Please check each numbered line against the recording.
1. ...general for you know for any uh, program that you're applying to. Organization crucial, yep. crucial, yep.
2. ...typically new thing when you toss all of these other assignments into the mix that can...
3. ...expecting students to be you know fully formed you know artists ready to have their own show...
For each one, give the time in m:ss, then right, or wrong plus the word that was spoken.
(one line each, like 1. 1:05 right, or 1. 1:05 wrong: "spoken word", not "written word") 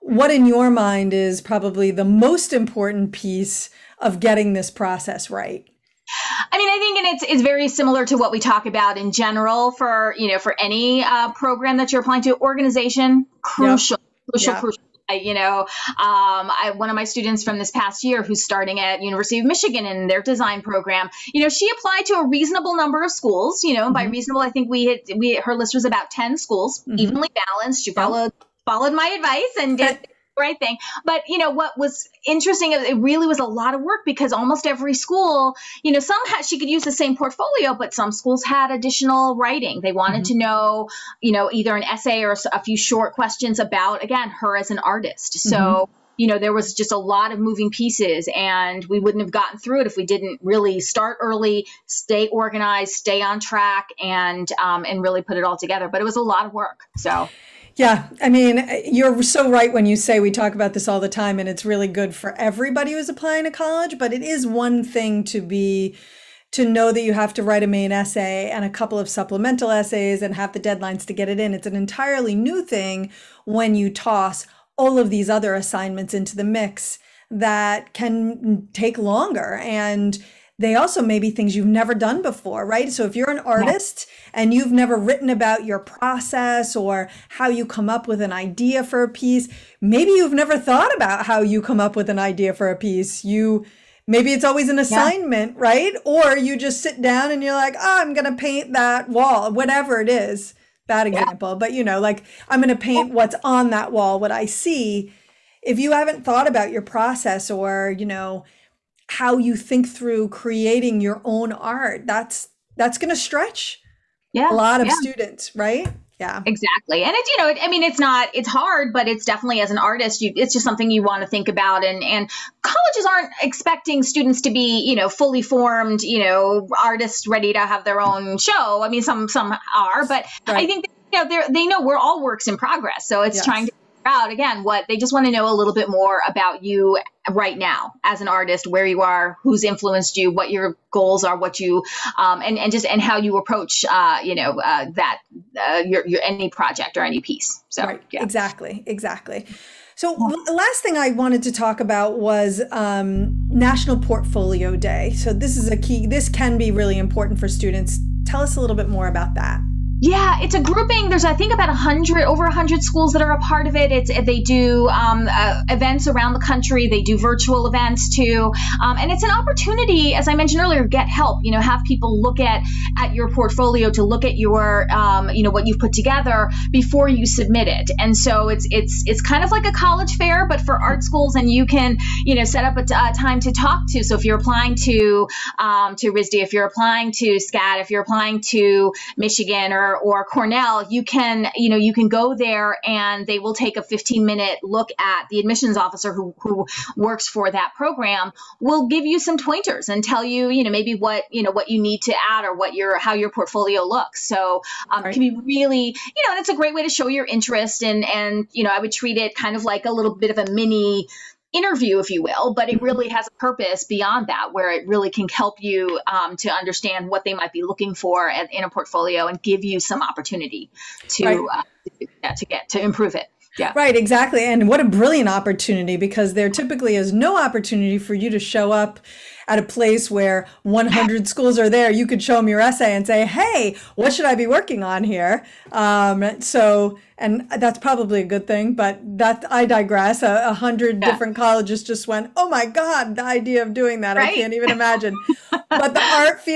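1. 0:09 right
2. 1:11 wrong: "entirely", not "typically"
3. 2:03 right.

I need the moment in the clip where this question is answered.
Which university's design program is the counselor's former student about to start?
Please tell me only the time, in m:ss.
0:19.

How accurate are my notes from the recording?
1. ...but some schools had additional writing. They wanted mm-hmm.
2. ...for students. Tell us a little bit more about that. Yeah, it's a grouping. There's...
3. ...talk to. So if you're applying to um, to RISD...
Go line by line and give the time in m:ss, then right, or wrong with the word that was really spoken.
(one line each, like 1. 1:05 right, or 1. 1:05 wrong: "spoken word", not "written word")
1. 0:37 right
2. 2:37 right
3. 3:03 right.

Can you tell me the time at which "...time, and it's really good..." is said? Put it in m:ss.
1:01.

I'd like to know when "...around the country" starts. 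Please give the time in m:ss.
2:46.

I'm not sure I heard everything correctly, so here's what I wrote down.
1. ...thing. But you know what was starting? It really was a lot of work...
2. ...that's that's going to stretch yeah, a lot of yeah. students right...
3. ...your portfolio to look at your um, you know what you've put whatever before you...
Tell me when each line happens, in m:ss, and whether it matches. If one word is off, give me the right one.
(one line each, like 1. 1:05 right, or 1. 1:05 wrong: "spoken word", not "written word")
1. 0:30 wrong: "interesting", not "starting"
2. 1:52 right
3. 2:53 wrong: "together", not "whatever".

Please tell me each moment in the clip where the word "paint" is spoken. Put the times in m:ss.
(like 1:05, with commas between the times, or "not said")
1:38, 1:42.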